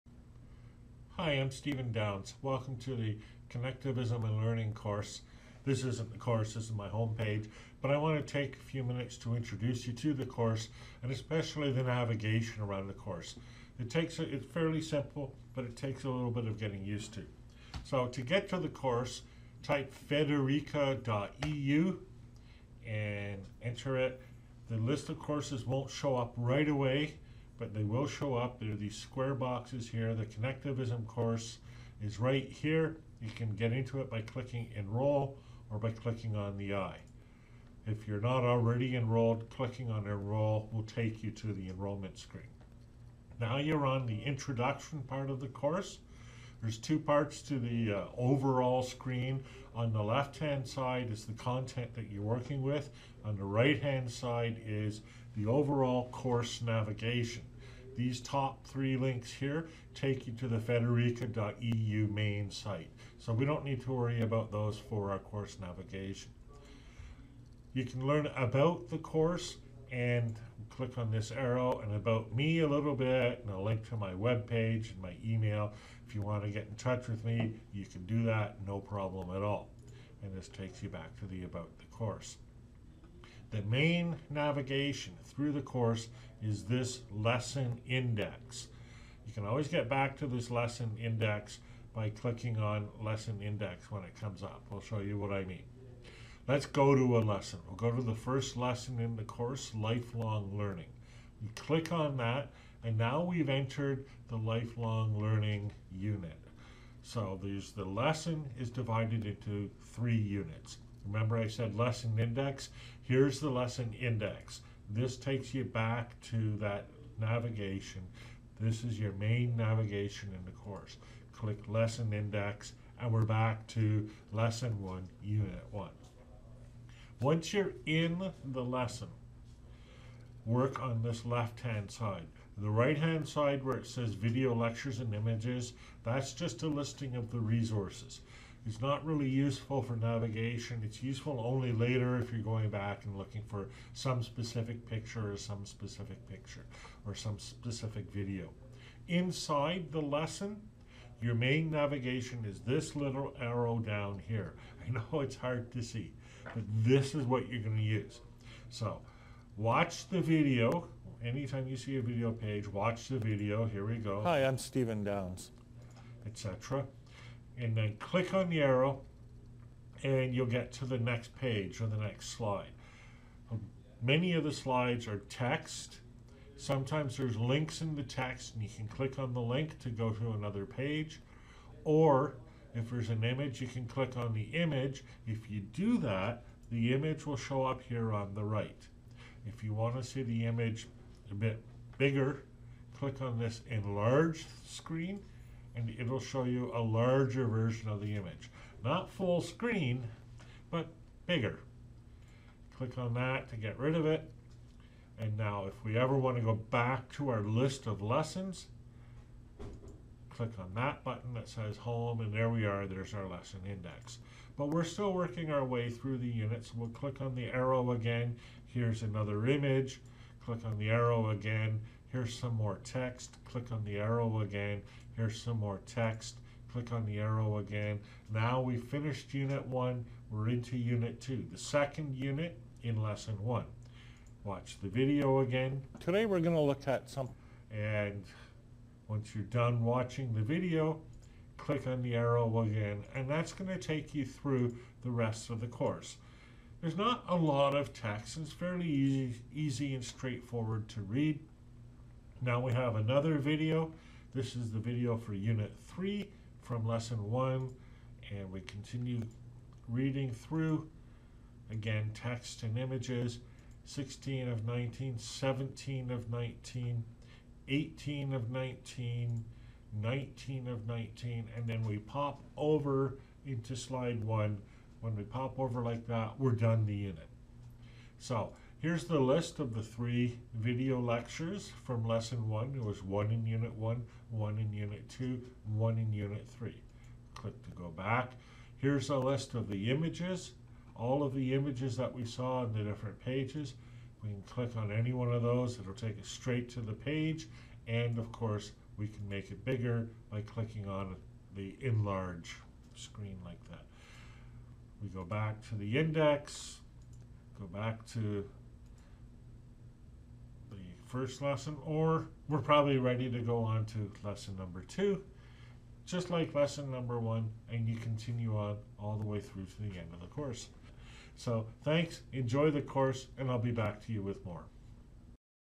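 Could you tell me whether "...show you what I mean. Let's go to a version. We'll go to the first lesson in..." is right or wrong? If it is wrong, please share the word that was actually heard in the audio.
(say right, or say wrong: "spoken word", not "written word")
wrong: "lesson", not "version".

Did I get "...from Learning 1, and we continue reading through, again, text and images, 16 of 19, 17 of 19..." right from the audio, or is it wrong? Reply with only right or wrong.
wrong.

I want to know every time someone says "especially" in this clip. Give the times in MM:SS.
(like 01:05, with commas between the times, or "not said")
00:11.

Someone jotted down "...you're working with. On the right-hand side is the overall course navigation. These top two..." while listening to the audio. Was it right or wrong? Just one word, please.
wrong.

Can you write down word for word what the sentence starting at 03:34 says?
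But we're still working our way through the units.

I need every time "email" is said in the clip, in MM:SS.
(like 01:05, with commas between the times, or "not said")
01:15.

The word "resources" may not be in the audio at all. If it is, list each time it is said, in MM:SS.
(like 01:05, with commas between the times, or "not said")
02:17.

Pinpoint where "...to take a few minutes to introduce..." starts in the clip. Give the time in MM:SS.
00:08.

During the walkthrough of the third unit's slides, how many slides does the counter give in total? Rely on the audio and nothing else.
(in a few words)
19.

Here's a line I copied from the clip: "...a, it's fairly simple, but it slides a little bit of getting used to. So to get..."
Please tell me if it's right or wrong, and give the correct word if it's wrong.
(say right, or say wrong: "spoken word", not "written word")
wrong: "takes", not "slides".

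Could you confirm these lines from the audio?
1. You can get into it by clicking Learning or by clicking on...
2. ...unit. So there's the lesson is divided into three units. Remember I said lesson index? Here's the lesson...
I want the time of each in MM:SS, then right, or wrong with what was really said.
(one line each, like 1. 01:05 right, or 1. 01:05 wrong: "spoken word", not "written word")
1. 00:33 wrong: "Enroll", not "Learning"
2. 01:45 right.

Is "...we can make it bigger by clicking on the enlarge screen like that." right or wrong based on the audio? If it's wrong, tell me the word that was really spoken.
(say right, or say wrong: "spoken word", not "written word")
right.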